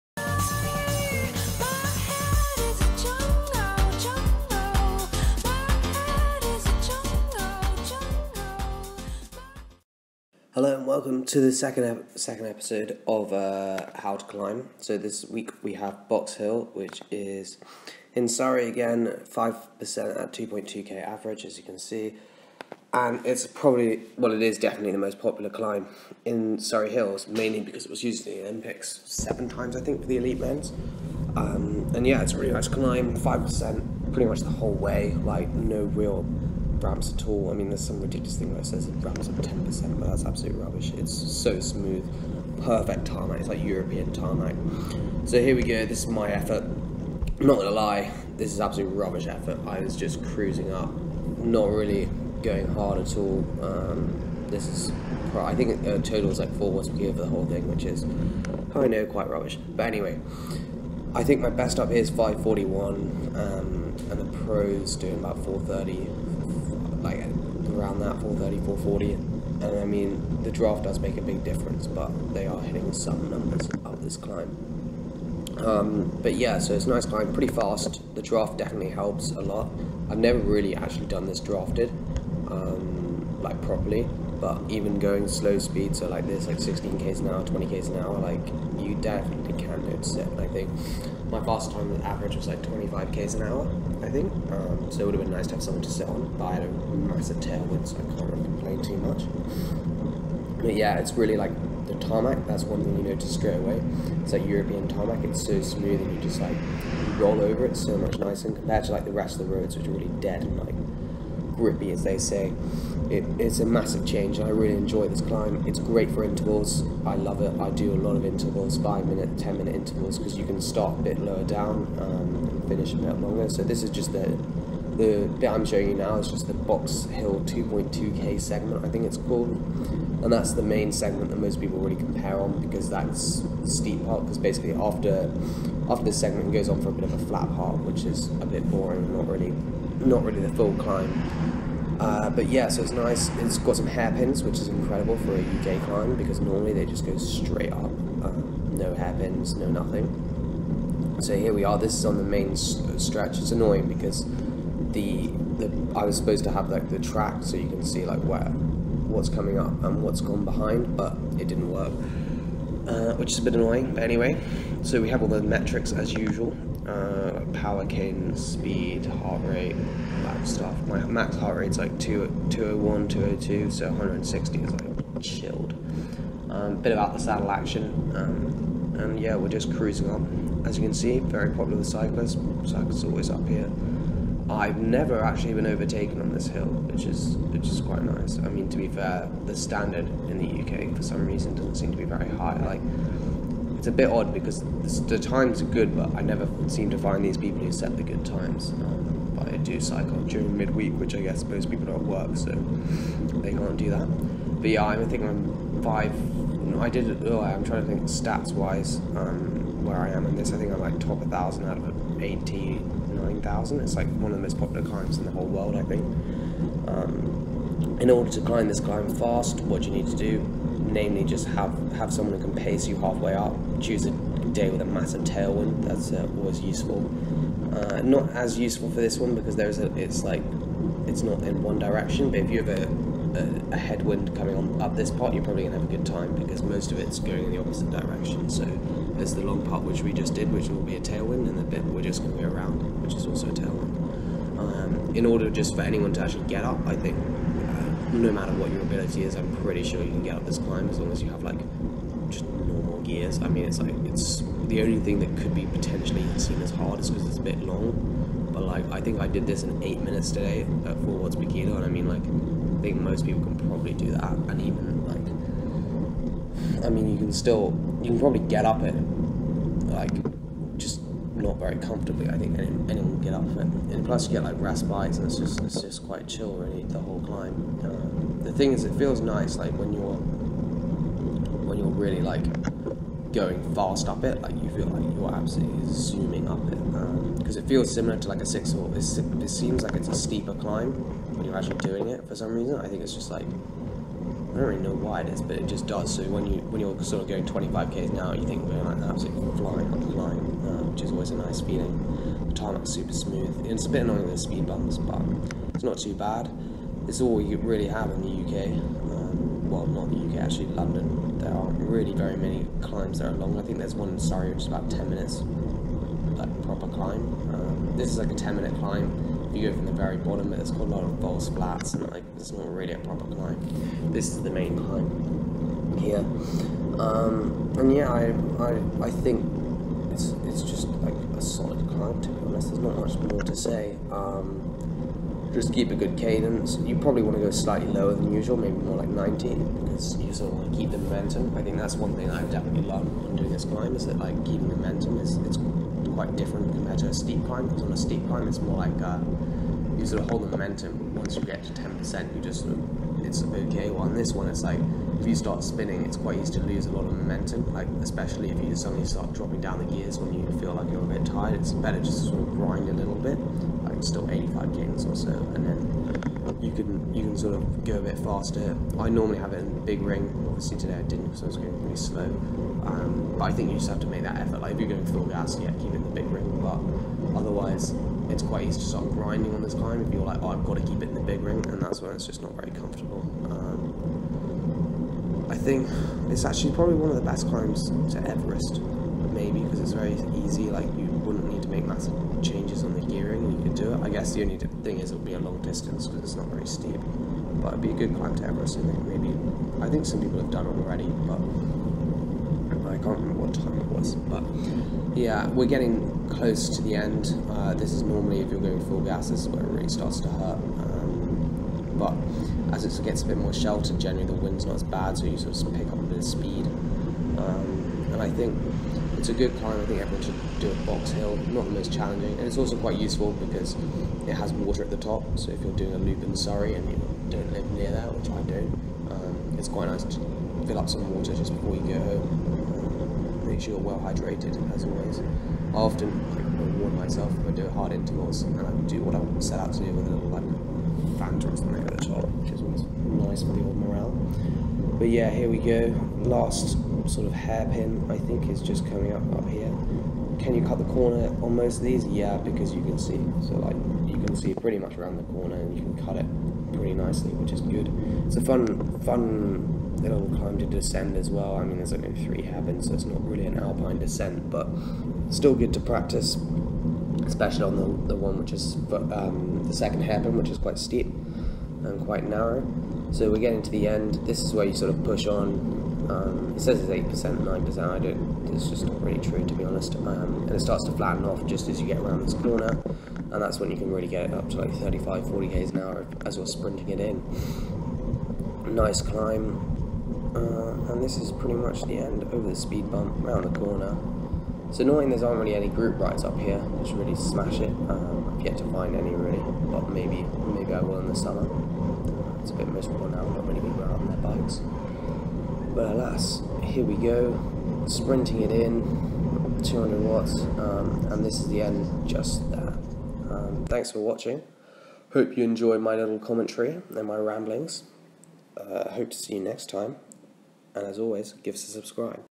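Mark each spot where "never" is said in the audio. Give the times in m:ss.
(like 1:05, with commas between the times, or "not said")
1:20, 3:04, 3:16.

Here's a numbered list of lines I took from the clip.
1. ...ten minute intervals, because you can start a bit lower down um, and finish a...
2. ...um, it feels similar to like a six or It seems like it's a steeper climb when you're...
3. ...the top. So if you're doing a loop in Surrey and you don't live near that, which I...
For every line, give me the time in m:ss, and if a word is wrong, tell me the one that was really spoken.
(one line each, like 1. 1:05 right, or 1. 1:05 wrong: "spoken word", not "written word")
1. 1:59 right
2. 4:47 right
3. 7:04 right.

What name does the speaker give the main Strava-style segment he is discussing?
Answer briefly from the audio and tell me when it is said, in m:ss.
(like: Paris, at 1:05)
Box Hill 2.2k, at 2:06.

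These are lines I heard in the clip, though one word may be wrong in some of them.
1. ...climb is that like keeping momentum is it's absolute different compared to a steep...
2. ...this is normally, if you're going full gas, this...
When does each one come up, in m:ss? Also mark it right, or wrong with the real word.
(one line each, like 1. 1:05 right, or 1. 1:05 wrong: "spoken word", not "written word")
1. 5:43 wrong: "quite", not "absolute"
2. 6:47 right.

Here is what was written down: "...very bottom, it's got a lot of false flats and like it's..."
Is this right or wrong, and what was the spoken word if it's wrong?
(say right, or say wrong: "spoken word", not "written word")
right.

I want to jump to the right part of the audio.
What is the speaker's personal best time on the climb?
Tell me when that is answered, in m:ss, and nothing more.
1:02.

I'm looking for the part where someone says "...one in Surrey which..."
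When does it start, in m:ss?
5:13.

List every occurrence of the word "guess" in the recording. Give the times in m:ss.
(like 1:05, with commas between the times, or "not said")
3:21, 6:34.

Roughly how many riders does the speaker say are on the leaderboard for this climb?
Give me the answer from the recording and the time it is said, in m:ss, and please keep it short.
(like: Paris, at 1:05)
89,000, at 3:32.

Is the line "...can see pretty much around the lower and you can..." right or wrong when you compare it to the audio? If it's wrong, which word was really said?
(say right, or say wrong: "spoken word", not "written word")
wrong: "corner", not "lower".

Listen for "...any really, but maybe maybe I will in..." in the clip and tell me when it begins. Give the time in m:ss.
8:18.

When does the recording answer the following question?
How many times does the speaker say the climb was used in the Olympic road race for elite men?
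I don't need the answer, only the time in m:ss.
0:29.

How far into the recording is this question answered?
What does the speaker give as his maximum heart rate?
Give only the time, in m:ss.
2:52.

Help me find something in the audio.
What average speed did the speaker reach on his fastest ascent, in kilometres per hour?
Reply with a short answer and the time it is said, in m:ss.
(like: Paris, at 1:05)
25, at 1:32.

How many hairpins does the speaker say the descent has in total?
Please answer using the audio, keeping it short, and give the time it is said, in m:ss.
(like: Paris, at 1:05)
3, at 7:42.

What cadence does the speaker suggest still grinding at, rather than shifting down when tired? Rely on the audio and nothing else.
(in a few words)
85.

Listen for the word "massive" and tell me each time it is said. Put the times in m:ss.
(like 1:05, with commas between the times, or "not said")
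1:36, 1:53, 3:44, 6:31.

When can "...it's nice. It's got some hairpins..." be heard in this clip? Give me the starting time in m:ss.
2:22.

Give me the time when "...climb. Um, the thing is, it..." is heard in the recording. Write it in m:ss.
4:37.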